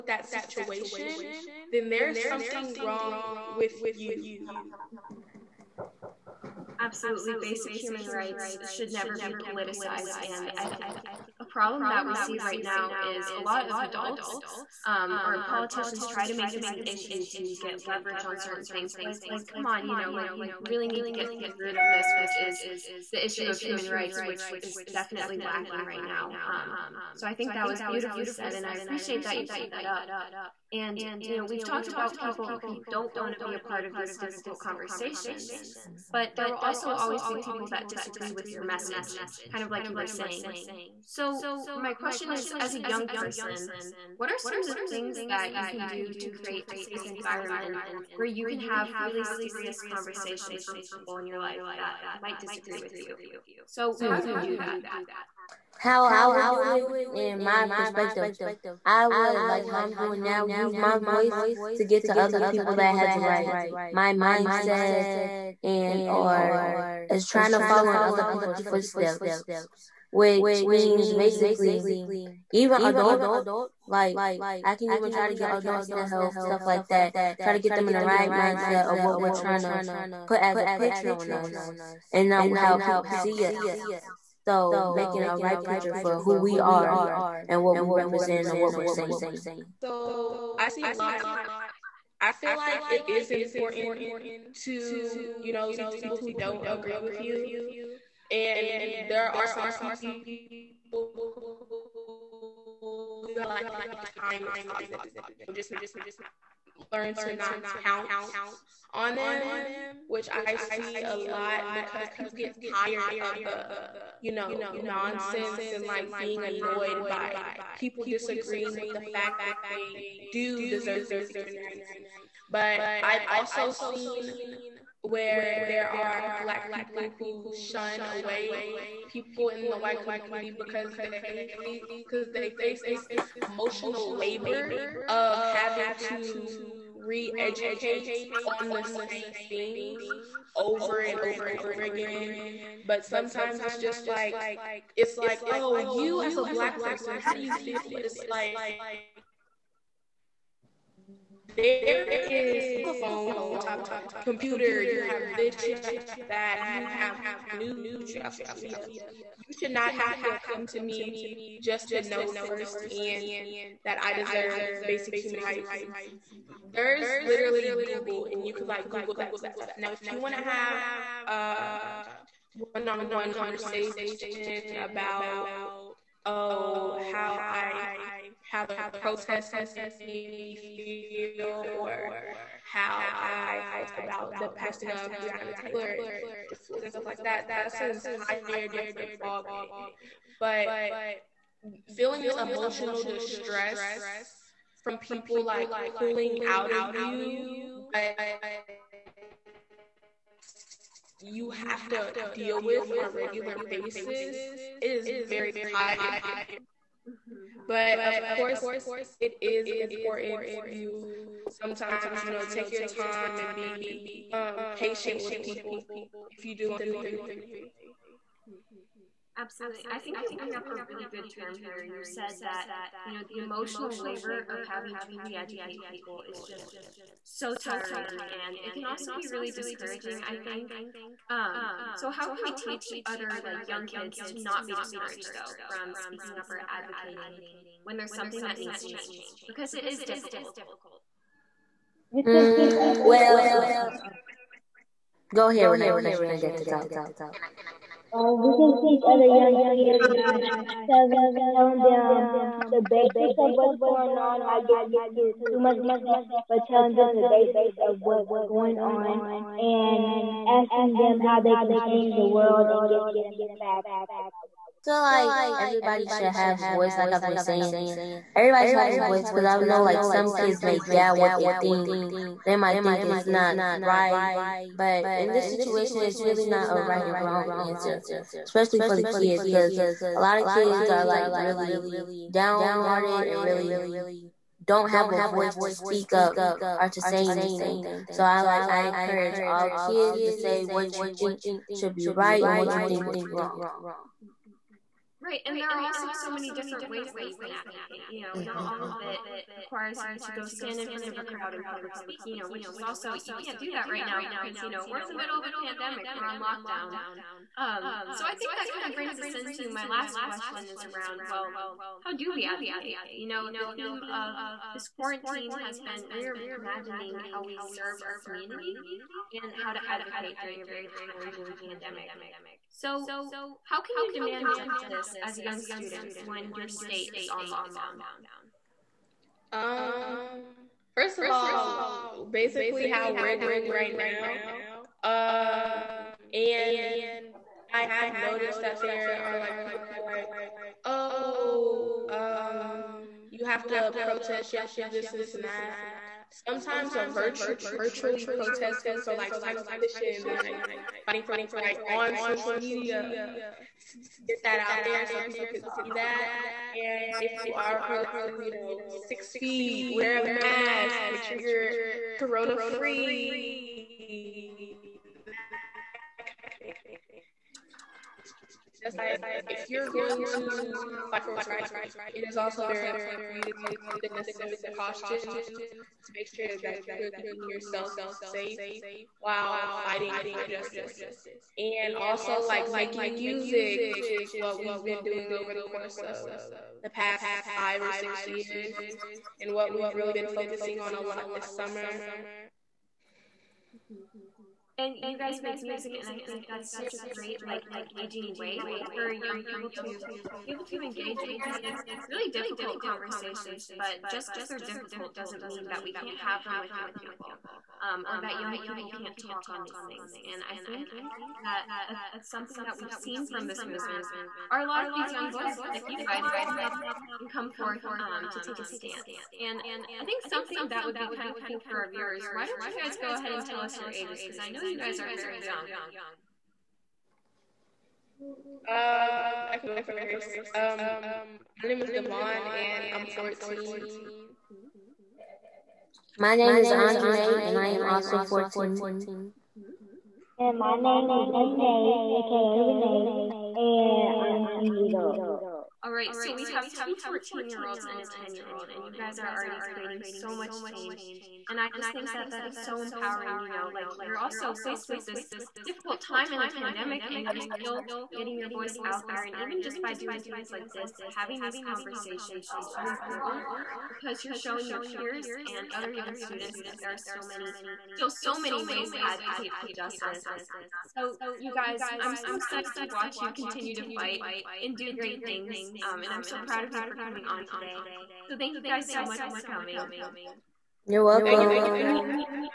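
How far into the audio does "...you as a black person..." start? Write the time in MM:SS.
02:25.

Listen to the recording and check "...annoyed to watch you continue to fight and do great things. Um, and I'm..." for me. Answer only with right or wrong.
wrong.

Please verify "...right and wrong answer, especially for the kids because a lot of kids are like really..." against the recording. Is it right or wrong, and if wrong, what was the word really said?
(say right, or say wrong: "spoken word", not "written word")
right.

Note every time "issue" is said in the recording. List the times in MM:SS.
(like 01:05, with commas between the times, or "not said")
00:16, 00:23.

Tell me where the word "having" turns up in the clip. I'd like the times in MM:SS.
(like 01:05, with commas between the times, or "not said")
02:15, 03:44, 07:41.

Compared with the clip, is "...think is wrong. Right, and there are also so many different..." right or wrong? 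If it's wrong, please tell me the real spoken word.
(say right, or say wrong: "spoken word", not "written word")
right.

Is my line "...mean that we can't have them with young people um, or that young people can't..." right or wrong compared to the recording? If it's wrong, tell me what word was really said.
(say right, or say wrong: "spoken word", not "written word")
right.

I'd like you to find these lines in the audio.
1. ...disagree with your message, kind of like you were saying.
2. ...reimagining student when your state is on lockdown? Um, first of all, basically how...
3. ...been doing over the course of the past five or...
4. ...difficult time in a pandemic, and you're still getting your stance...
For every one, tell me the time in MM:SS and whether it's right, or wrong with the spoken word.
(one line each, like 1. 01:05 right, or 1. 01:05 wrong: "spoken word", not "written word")
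1. 00:37 right
2. 05:25 wrong: "young", not "reimagining"
3. 06:24 right
4. 07:35 wrong: "voice", not "stance".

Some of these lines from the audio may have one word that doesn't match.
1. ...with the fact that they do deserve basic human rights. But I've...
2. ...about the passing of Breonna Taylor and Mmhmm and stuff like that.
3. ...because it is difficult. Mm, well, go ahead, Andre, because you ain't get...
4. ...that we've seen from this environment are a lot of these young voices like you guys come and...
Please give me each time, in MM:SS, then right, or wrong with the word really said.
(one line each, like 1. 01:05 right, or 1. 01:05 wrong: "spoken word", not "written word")
1. 01:58 right
2. 03:03 wrong: "Floyd", not "Mmhmm"
3. 03:59 wrong: "Renee", not "Andre"
4. 06:52 wrong: "movement", not "environment".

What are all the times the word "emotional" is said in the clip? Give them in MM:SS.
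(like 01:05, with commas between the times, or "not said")
02:13, 03:12, 03:43.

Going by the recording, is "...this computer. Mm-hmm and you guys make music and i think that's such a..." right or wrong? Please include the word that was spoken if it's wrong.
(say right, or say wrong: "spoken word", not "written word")
wrong: "summer", not "computer".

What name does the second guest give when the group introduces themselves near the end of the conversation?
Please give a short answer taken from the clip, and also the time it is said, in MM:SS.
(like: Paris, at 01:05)
Andre, at 07:16.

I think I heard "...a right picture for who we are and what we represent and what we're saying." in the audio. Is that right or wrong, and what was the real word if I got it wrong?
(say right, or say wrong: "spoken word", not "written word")
right.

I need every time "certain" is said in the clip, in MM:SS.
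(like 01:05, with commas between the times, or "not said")
00:18.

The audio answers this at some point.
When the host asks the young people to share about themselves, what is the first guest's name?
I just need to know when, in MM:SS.
07:11.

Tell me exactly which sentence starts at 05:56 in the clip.
And if you are protesting, you know, six feet, wear a mask, make sure you're corona free.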